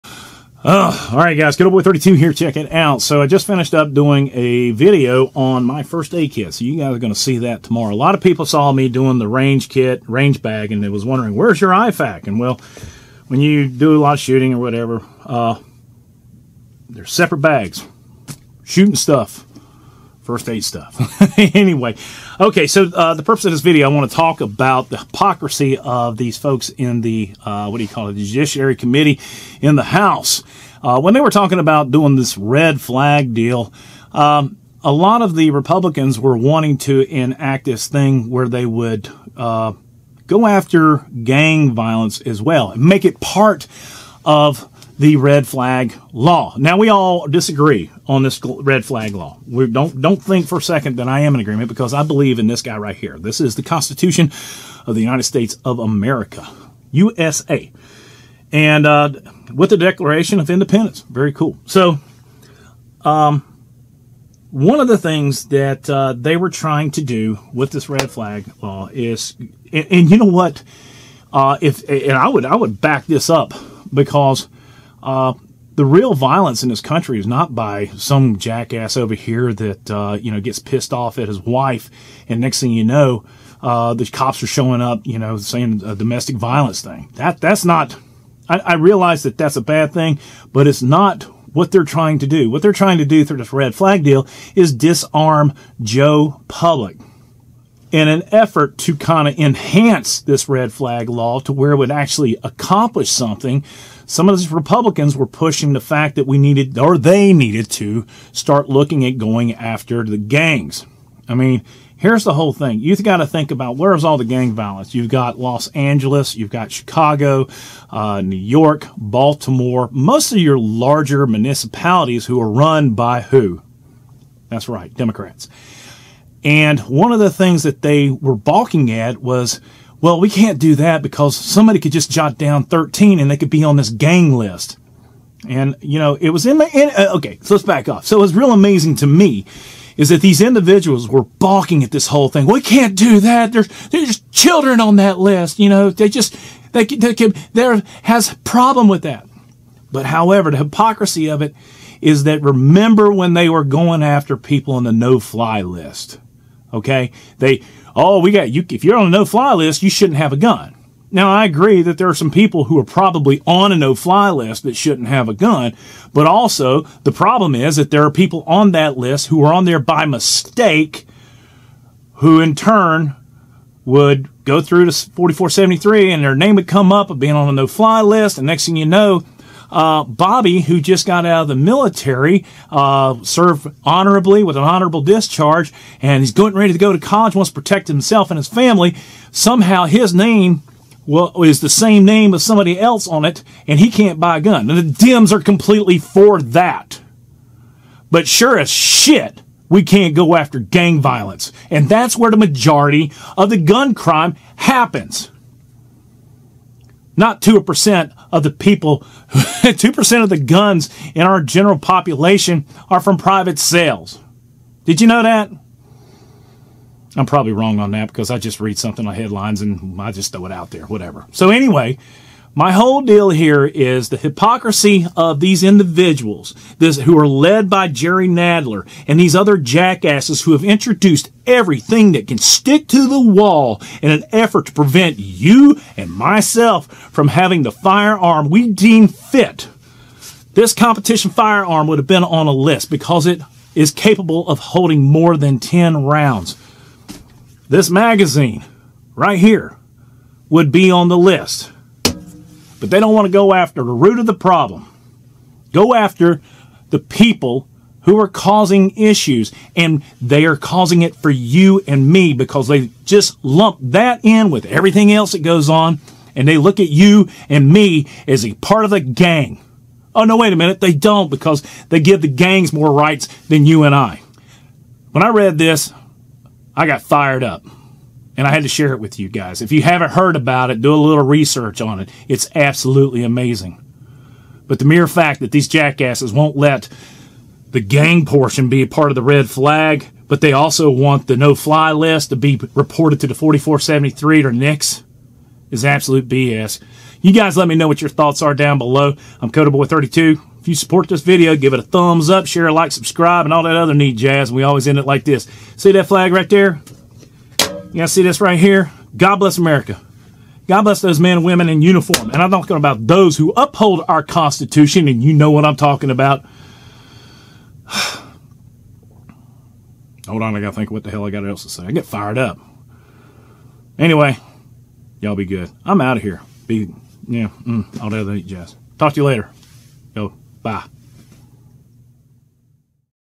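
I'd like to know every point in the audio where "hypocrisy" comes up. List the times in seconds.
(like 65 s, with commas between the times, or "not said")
24 s, 150 s, 224 s.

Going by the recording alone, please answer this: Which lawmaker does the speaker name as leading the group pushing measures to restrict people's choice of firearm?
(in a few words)
Jerry Nadler.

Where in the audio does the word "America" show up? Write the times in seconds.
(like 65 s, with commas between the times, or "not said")
55 s, 309 s.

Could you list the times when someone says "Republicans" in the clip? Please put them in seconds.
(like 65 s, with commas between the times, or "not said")
35 s, 104 s.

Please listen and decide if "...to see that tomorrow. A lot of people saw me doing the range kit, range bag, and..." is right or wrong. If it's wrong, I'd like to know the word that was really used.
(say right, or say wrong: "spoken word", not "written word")
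right.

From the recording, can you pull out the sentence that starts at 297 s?
You guys let me know what your thoughts are down below.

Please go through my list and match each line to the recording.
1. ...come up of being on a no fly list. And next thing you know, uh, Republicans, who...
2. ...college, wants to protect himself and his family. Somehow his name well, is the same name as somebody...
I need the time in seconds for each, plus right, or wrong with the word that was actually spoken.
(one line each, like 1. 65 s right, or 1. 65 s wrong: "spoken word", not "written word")
1. 176 s wrong: "Bobby", not "Republicans"
2. 186 s right.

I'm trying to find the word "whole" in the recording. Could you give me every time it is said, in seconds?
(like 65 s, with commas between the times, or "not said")
112 s, 142 s, 222 s.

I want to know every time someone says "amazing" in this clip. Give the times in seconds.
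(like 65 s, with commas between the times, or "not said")
138 s, 283 s.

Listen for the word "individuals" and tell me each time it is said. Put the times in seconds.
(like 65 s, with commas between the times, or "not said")
140 s, 225 s.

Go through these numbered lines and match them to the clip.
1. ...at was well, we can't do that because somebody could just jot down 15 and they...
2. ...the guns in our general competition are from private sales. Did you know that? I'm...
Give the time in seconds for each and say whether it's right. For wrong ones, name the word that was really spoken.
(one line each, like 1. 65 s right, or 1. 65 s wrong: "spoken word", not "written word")
1. 128 s wrong: "13", not "15"
2. 210 s wrong: "population", not "competition".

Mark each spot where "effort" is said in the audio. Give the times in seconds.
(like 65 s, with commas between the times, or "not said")
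98 s, 234 s.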